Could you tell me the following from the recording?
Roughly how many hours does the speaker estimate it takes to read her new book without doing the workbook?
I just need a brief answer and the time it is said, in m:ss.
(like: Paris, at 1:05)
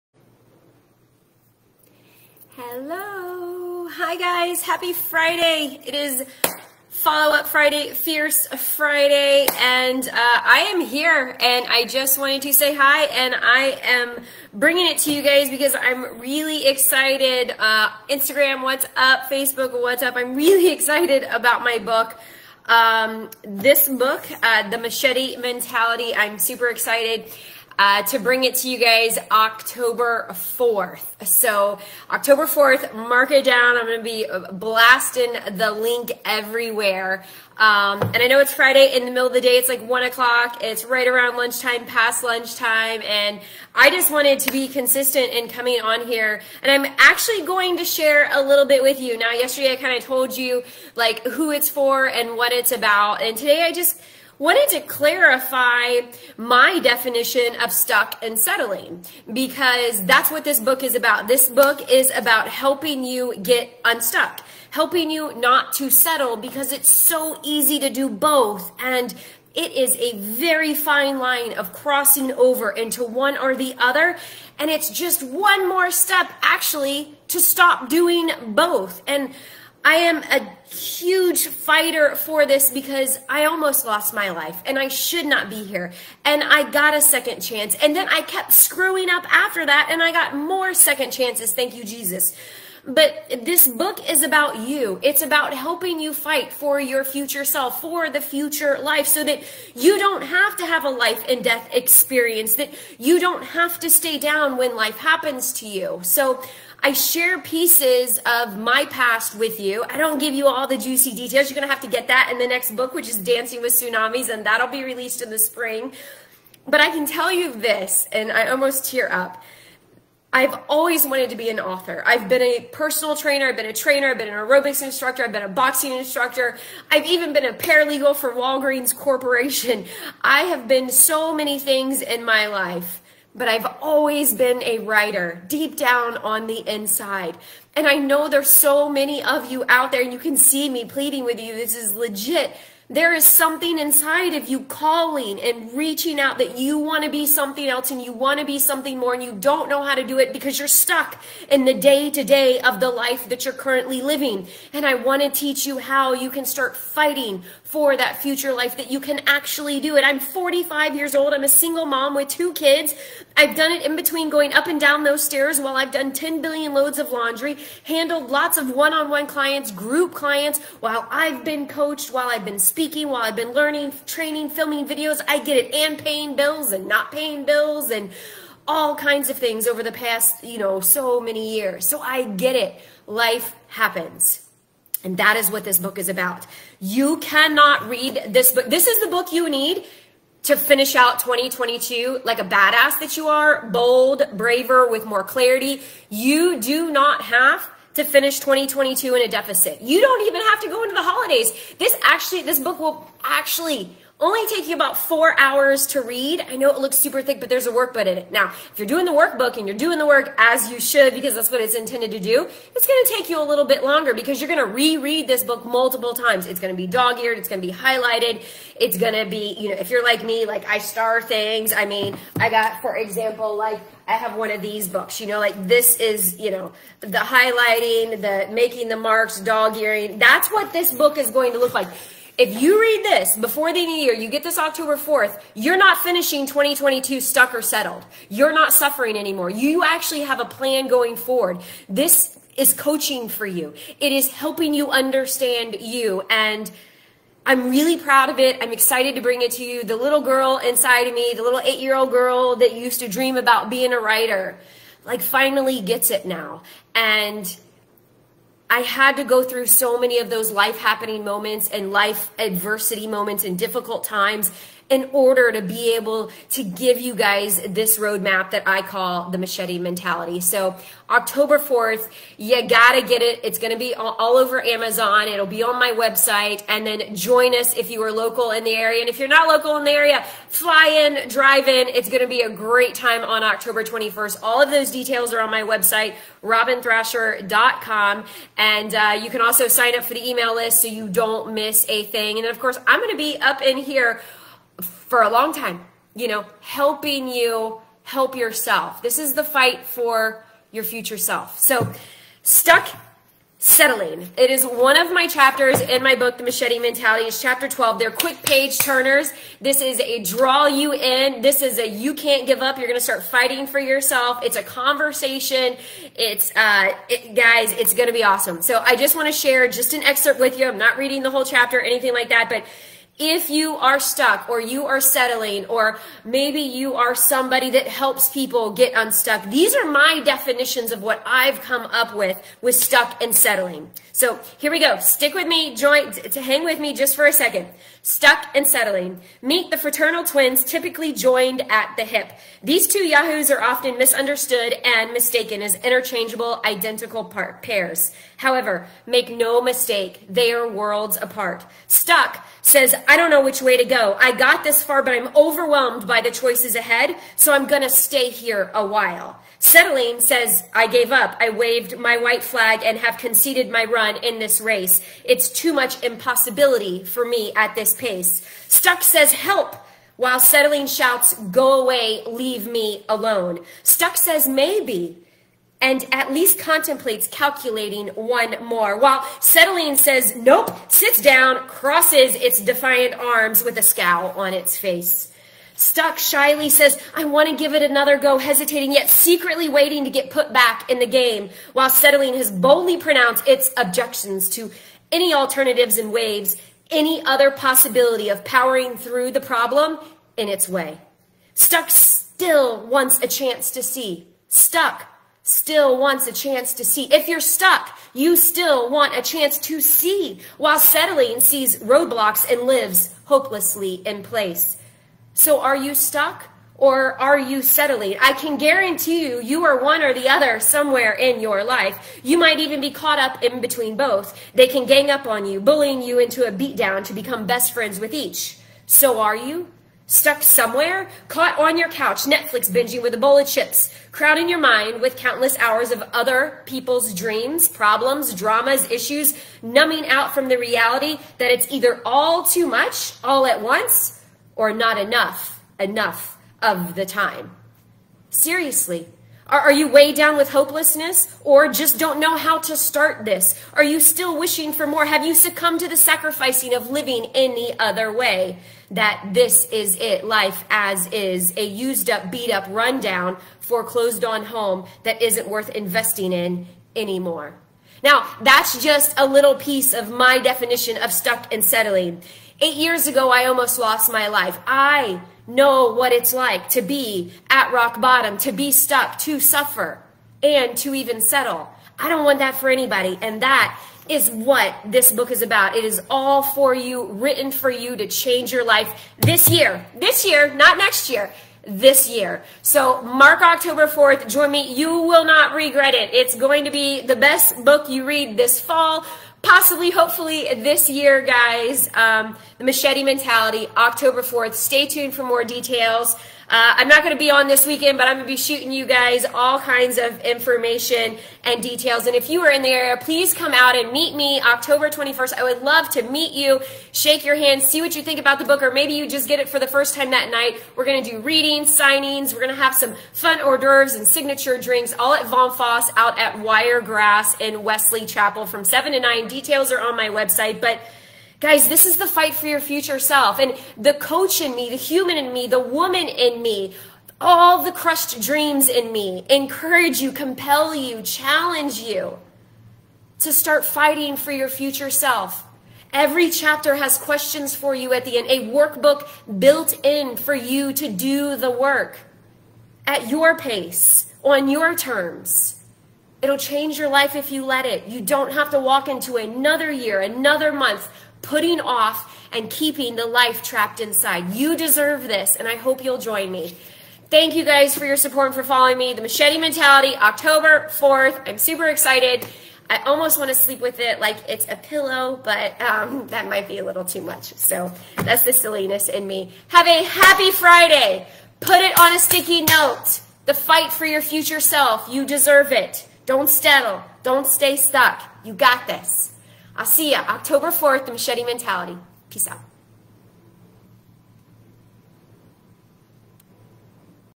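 4, at 3:24.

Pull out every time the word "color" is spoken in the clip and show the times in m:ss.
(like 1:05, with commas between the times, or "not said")
not said.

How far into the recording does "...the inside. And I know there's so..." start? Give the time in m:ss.
2:16.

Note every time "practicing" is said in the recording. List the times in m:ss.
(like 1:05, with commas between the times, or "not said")
not said.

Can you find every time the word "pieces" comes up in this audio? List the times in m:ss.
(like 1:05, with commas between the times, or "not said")
1:47, 7:49.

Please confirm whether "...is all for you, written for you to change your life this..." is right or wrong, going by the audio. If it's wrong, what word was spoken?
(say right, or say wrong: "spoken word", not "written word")
right.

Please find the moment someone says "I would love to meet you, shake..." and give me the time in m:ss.
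8:35.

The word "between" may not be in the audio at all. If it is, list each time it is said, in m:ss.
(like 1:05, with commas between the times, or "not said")
2:43, 7:03.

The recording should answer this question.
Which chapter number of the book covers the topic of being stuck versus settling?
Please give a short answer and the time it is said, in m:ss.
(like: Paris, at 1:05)
12, at 5:07.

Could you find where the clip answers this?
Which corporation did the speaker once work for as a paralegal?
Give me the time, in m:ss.
2:08.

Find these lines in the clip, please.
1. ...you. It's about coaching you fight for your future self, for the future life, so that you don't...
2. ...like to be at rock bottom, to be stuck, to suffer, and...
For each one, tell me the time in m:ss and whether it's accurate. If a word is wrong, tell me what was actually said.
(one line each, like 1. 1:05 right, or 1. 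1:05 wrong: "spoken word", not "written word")
1. 1:34 wrong: "helping", not "coaching"
2. 7:56 right.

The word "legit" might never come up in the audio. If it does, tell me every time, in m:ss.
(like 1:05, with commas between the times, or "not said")
2:21.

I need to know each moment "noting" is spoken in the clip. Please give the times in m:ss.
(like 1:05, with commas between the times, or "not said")
not said.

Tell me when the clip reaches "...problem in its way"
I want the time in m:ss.
6:39.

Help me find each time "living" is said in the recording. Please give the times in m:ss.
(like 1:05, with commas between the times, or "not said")
2:34, 7:36.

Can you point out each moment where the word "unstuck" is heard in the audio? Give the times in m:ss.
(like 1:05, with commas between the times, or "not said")
1:03, 5:28.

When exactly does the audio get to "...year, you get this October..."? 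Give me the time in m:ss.
3:53.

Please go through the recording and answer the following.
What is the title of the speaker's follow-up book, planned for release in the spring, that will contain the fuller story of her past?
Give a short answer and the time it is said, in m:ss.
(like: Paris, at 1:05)
Dancing with Tsunamis, at 1:53.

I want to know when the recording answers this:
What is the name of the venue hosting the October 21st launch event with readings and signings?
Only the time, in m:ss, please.
8:45.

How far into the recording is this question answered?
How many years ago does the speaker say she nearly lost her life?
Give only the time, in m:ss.
7:52.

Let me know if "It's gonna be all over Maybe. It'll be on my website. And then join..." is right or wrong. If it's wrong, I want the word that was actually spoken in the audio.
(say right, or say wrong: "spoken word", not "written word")
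wrong: "Amazon", not "Maybe".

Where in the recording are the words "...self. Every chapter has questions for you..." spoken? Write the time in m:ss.
9:05.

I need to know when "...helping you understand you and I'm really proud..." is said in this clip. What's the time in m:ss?
4:04.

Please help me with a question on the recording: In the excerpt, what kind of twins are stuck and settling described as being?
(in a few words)
Fraternal twins.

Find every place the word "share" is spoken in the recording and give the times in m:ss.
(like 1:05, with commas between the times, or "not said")
0:47, 1:46, 5:19.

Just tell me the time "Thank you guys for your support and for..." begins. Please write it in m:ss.
9:27.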